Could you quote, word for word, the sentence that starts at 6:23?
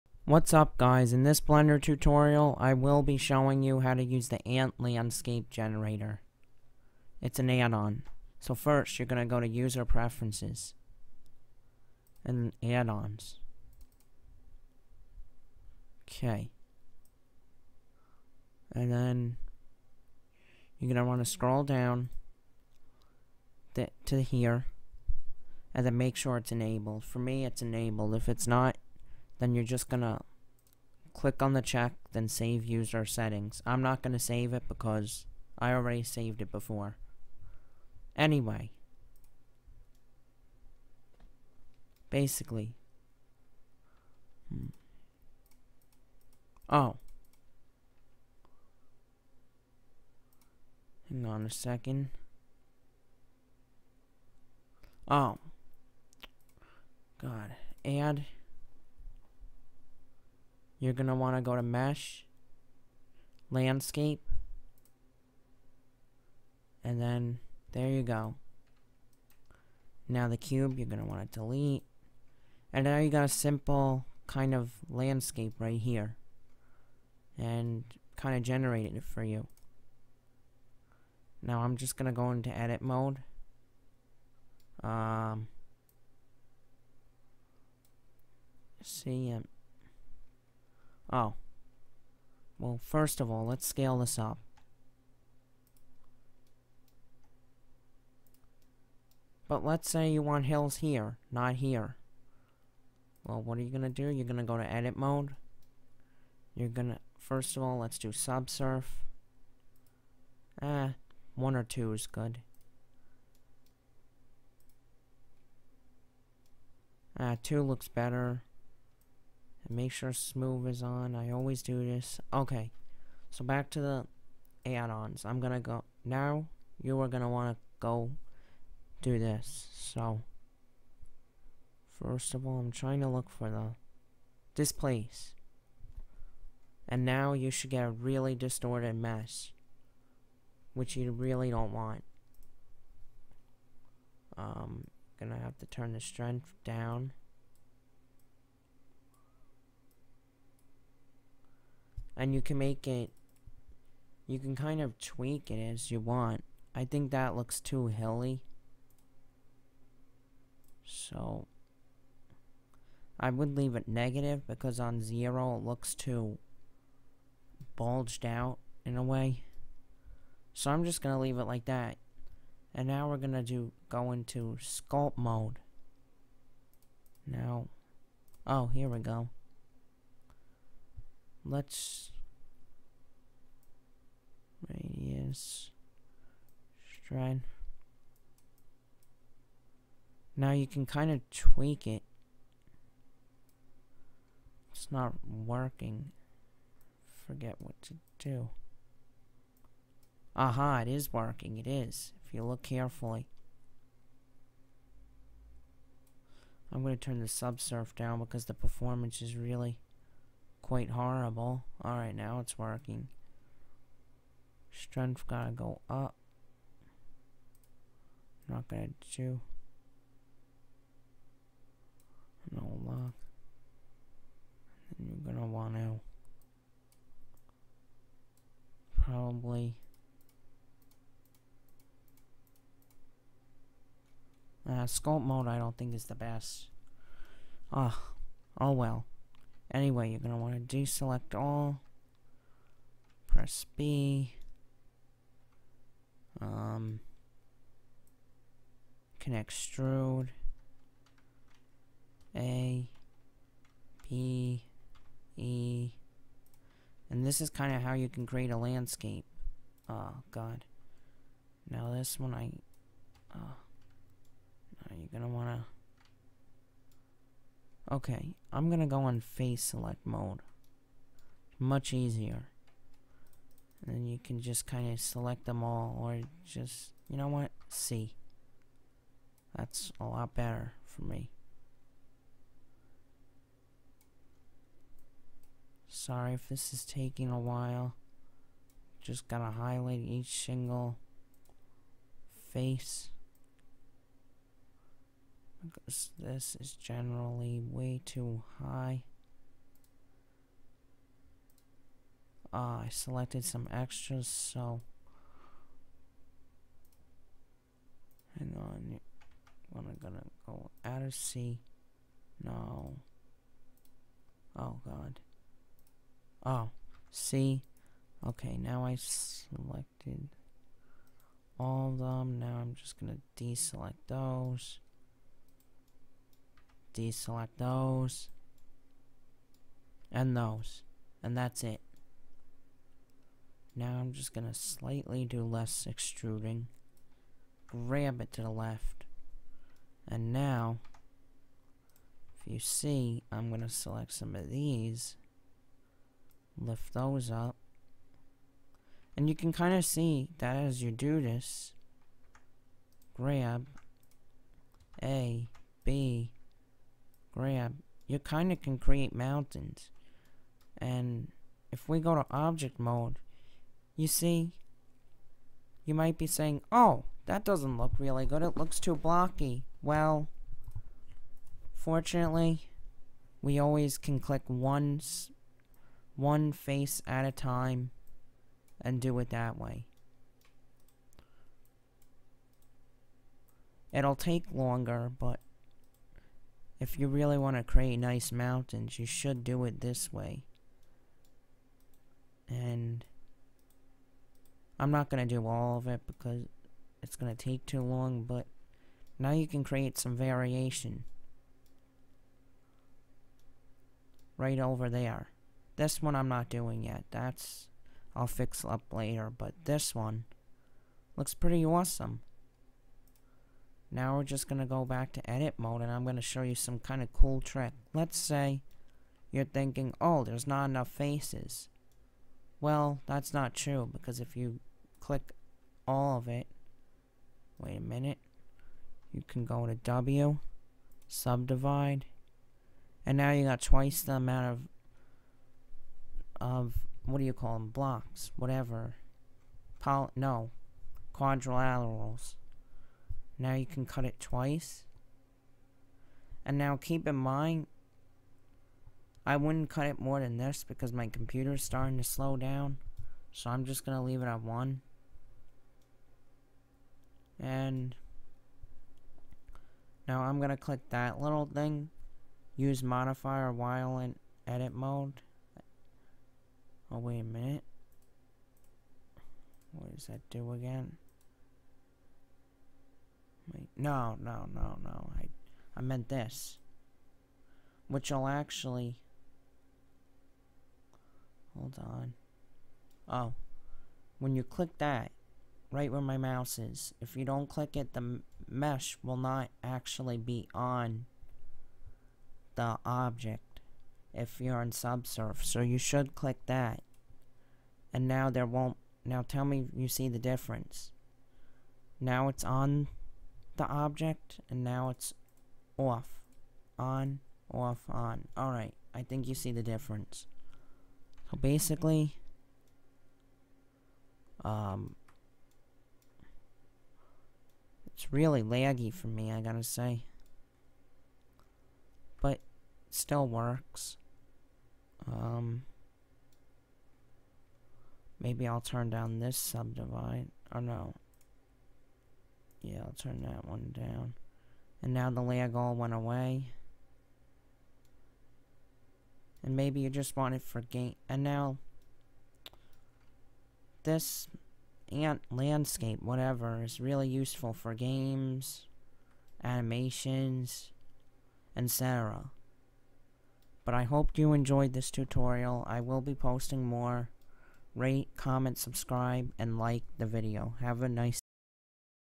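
It'll take longer, but if you really want to create nice mountains, you should do it this way.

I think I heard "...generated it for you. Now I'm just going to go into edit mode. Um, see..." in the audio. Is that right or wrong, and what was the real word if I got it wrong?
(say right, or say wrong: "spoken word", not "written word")
right.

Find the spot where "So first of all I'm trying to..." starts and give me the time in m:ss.
2:09.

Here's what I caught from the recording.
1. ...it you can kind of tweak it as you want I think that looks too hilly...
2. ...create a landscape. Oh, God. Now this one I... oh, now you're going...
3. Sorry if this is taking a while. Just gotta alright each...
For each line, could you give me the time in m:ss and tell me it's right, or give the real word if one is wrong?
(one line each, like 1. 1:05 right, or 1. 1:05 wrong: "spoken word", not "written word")
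1. 2:32 right
2. 4:18 right
3. 4:45 wrong: "highlight", not "alright".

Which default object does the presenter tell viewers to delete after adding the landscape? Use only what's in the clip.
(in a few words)
the cube.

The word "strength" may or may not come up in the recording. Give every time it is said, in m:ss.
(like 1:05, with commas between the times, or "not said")
2:26, 3:34.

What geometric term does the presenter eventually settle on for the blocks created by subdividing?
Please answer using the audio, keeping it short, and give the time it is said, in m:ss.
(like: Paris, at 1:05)
quadrilaterals, at 7:21.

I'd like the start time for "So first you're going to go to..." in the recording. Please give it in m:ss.
0:08.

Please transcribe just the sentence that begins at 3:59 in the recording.
Anyway, you're going to want to deselect all.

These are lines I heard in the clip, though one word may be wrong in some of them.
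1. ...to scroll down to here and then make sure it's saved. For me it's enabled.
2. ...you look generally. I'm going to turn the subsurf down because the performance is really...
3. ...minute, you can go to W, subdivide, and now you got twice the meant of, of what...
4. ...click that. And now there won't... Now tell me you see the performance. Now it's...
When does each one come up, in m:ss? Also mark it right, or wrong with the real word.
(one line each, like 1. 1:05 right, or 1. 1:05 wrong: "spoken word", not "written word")
1. 0:21 wrong: "enabled", not "saved"
2. 3:22 wrong: "carefully", not "generally"
3. 7:07 wrong: "amount", not "meant"
4. 8:16 wrong: "difference", not "performance".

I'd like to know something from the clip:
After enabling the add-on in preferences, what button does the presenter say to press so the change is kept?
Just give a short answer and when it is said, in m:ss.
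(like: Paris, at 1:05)
save user settings, at 0:32.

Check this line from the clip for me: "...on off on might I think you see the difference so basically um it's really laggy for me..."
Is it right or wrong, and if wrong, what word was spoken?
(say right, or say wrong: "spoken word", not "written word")
wrong: "alright", not "might".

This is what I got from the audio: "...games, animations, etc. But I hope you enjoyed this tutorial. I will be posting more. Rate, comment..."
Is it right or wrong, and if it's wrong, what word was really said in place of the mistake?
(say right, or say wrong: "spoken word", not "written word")
right.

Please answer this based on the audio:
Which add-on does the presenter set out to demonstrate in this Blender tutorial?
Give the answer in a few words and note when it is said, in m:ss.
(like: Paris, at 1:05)
Ant Landscape Generator, at 0:04.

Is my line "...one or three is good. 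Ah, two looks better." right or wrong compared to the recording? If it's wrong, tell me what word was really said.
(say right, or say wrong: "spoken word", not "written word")
wrong: "two", not "three".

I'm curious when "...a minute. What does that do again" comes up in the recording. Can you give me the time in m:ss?
7:47.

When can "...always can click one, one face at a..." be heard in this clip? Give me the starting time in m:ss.
6:13.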